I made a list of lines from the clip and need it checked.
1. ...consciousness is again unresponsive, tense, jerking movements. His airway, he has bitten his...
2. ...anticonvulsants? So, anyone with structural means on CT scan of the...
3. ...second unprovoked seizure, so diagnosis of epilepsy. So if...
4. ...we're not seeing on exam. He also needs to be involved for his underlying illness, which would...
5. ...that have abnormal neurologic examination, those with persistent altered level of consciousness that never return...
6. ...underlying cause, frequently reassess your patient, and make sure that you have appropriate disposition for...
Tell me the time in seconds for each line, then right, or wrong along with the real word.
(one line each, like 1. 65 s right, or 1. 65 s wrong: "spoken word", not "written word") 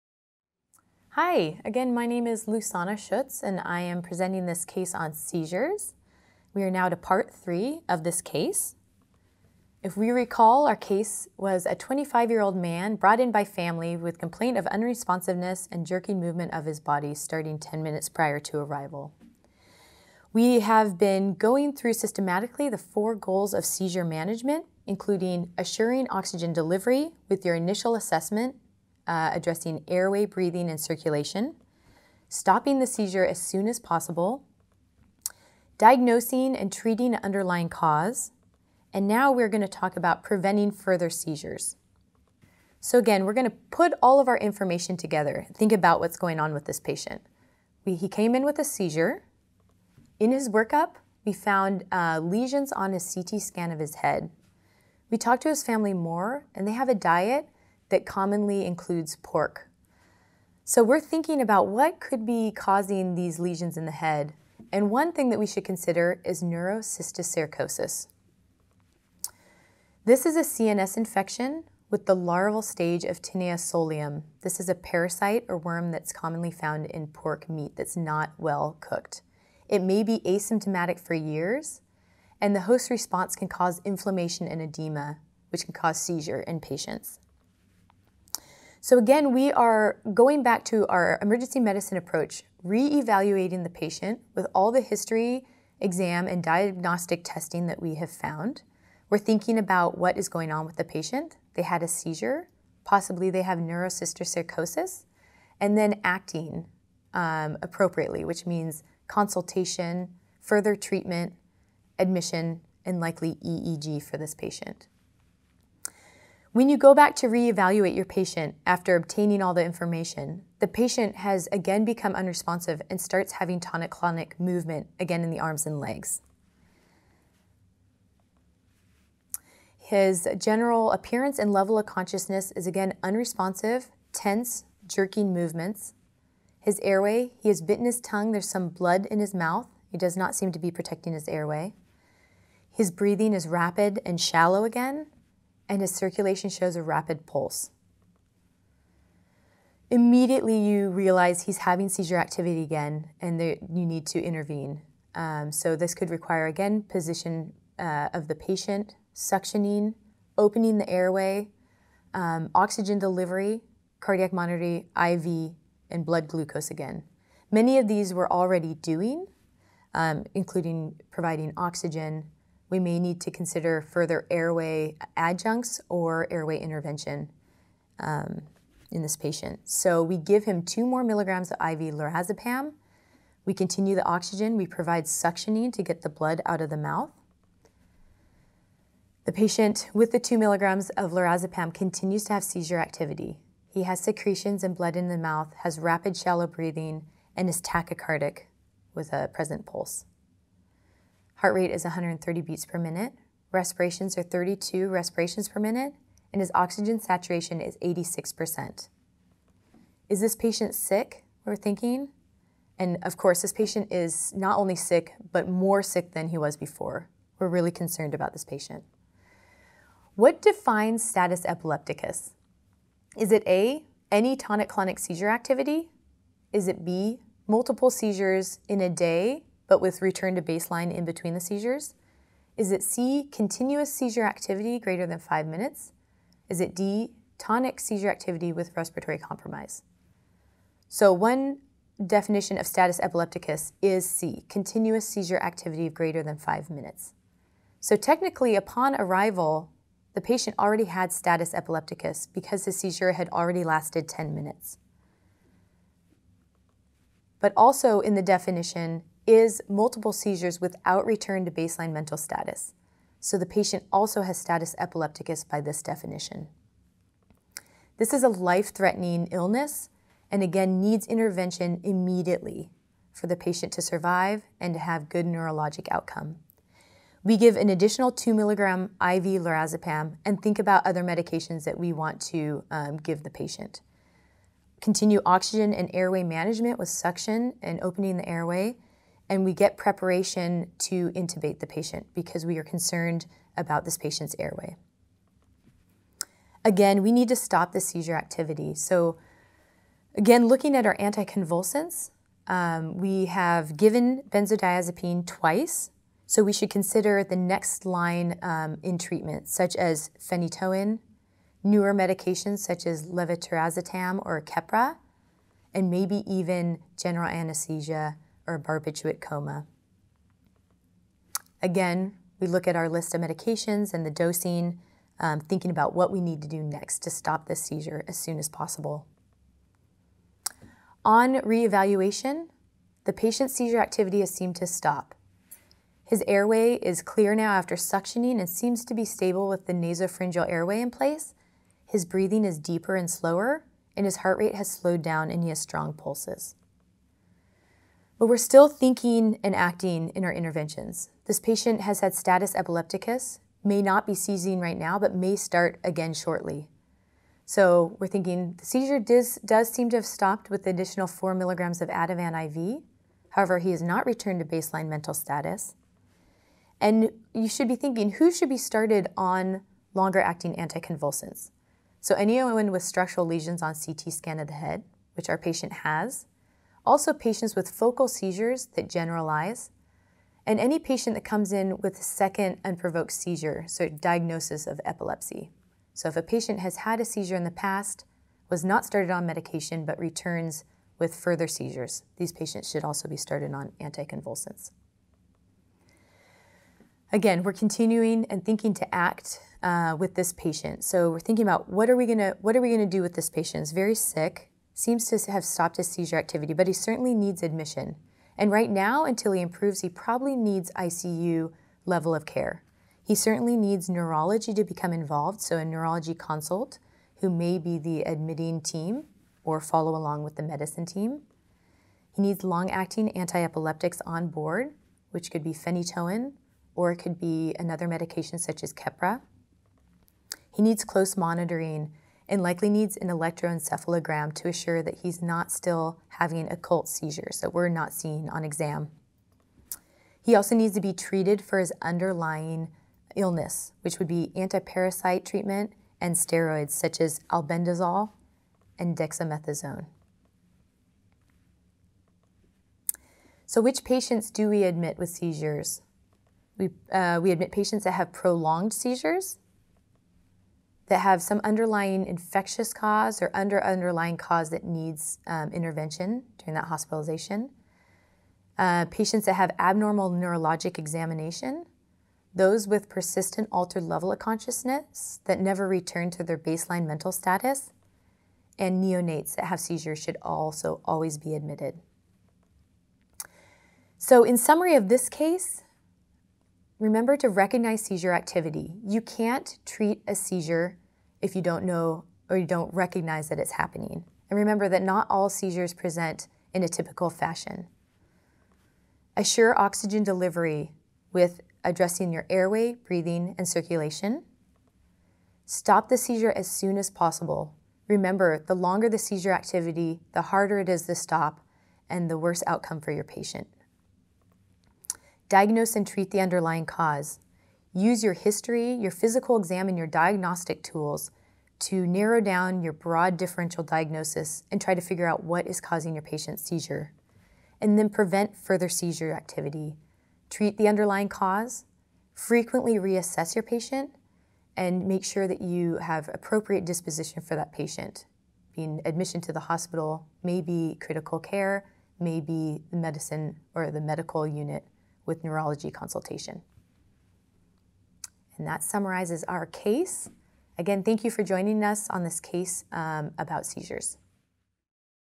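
1. 131 s right
2. 370 s wrong: "lesions", not "means"
3. 381 s right
4. 437 s wrong: "treated", not "involved"
5. 469 s right
6. 530 s right.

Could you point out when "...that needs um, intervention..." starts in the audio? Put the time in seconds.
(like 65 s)
464 s.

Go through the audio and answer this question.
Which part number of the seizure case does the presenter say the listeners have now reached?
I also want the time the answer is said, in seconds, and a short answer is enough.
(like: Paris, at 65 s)
three, at 6 s.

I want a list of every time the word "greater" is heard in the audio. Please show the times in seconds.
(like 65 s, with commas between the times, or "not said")
234 s, 245 s.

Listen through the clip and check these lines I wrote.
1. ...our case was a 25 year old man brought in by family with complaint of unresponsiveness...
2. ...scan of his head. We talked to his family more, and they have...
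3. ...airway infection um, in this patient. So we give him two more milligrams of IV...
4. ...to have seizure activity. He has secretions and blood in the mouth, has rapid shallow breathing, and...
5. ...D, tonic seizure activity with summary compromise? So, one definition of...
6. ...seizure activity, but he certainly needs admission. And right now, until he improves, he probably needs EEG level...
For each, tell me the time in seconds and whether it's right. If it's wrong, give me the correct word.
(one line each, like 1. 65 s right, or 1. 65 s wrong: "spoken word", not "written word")
1. 10 s right
2. 53 s right
3. 176 s wrong: "intervention", not "infection"
4. 192 s right
5. 236 s wrong: "respiratory", not "summary"
6. 405 s wrong: "ICU", not "EEG".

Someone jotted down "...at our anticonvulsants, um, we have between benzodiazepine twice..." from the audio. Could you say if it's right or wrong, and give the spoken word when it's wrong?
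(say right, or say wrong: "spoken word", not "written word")
wrong: "given", not "between".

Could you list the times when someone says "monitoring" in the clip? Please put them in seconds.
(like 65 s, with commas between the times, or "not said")
164 s, 431 s.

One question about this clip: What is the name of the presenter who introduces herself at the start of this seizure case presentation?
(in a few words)
Lusana Schutz.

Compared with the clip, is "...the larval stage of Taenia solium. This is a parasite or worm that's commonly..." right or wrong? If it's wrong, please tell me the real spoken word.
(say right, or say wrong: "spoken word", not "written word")
right.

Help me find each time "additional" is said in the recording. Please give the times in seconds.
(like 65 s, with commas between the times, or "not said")
277 s, 360 s.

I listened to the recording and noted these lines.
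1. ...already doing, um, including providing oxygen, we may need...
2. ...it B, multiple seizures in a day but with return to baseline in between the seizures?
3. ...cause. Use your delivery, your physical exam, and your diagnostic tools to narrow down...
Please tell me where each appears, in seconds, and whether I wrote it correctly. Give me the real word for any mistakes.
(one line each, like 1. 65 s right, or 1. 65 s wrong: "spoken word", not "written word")
1. 168 s right
2. 226 s right
3. 516 s wrong: "history", not "delivery".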